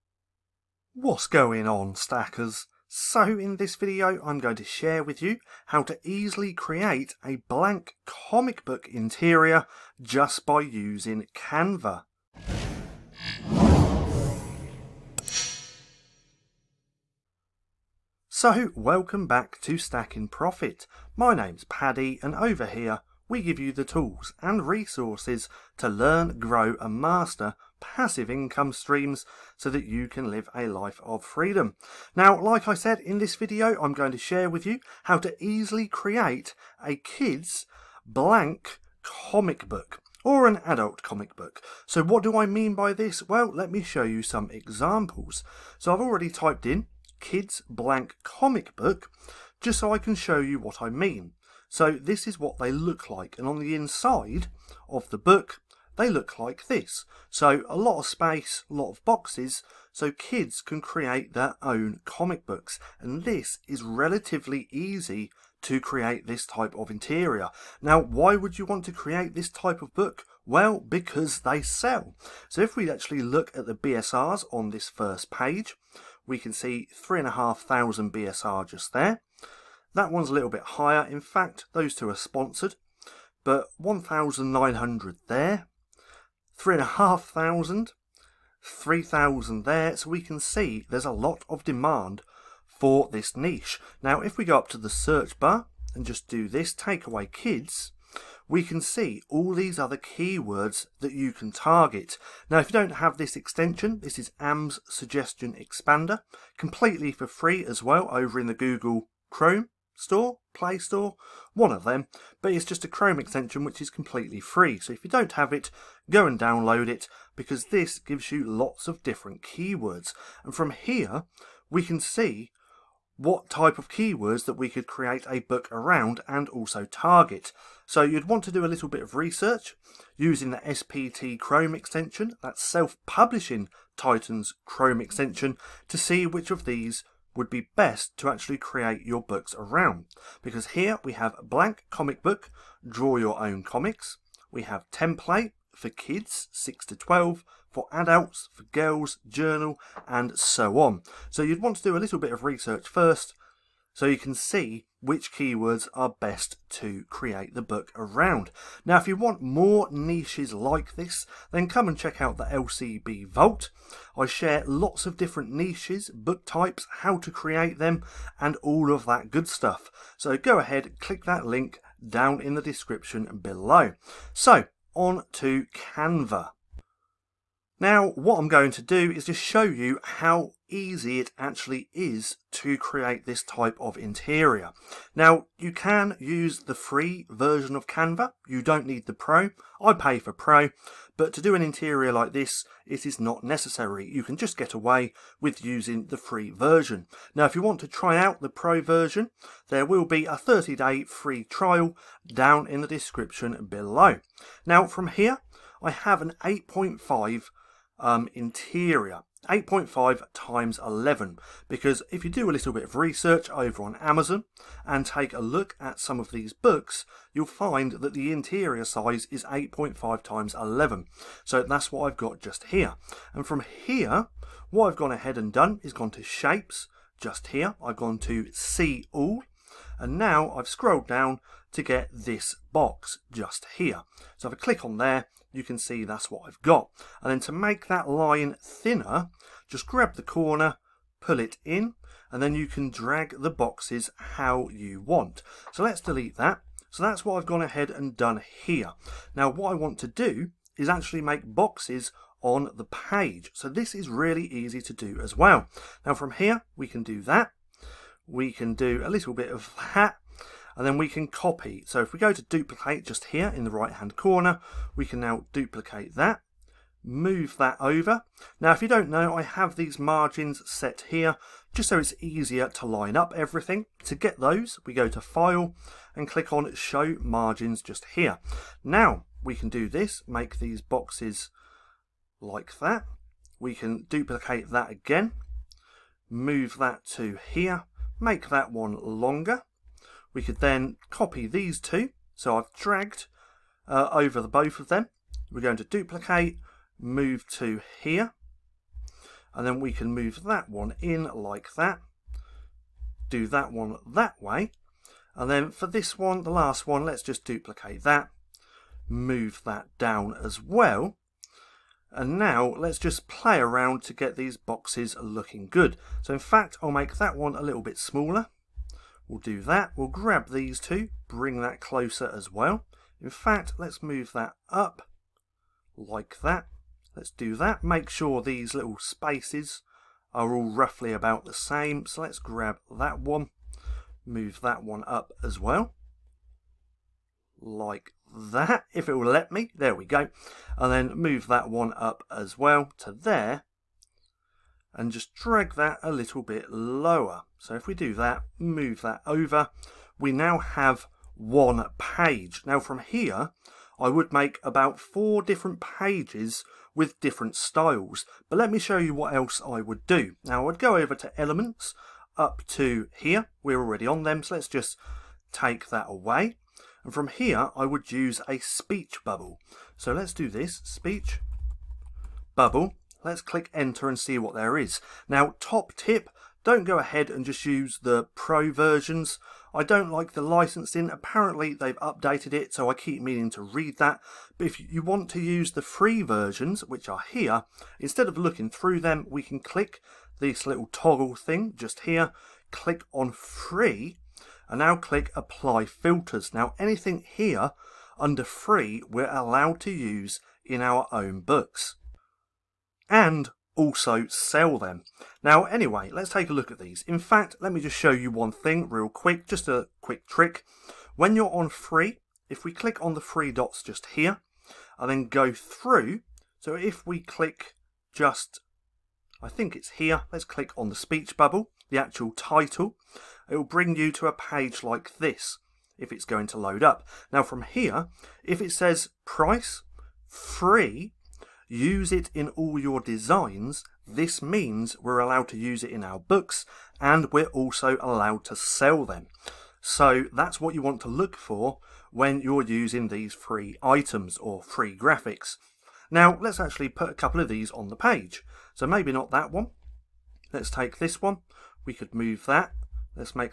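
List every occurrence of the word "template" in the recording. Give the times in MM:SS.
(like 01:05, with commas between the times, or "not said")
02:24.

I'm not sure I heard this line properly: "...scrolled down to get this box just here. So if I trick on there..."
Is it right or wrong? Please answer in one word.
wrong.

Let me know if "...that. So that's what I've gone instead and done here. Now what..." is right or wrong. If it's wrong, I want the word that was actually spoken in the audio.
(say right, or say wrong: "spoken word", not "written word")
wrong: "ahead", not "instead".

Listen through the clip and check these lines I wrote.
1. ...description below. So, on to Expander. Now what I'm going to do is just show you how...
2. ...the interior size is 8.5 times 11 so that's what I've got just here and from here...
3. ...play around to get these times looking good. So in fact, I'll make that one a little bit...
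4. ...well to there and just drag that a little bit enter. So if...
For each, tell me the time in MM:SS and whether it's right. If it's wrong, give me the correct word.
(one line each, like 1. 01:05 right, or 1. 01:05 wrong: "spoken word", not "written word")
1. 02:52 wrong: "Canva", not "Expander"
2. 03:38 right
3. 05:13 wrong: "boxes", not "times"
4. 05:42 wrong: "lower", not "enter".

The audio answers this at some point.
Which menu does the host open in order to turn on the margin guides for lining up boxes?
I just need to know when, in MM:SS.
04:35.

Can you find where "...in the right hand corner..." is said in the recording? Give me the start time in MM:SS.
04:23.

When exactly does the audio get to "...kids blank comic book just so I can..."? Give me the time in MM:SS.
00:47.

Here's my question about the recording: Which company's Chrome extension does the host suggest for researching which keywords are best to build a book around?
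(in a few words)
Self-Publishing Titan.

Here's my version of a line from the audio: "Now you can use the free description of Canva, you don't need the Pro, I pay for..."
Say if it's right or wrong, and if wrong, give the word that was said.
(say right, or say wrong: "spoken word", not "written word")
wrong: "version", not "description".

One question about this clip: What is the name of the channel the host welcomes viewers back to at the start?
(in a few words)
Stacking Profit.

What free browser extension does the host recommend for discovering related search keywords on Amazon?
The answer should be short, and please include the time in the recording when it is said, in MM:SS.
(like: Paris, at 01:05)
AMZ Suggestion Expander, at 01:44.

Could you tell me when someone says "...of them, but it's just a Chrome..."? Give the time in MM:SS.
01:51.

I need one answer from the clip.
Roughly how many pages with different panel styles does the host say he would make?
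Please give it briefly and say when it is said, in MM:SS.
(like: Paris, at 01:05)
4, at 05:54.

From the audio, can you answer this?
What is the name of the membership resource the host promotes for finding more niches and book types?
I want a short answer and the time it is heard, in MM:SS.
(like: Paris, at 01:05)
LCB Vault, at 02:42.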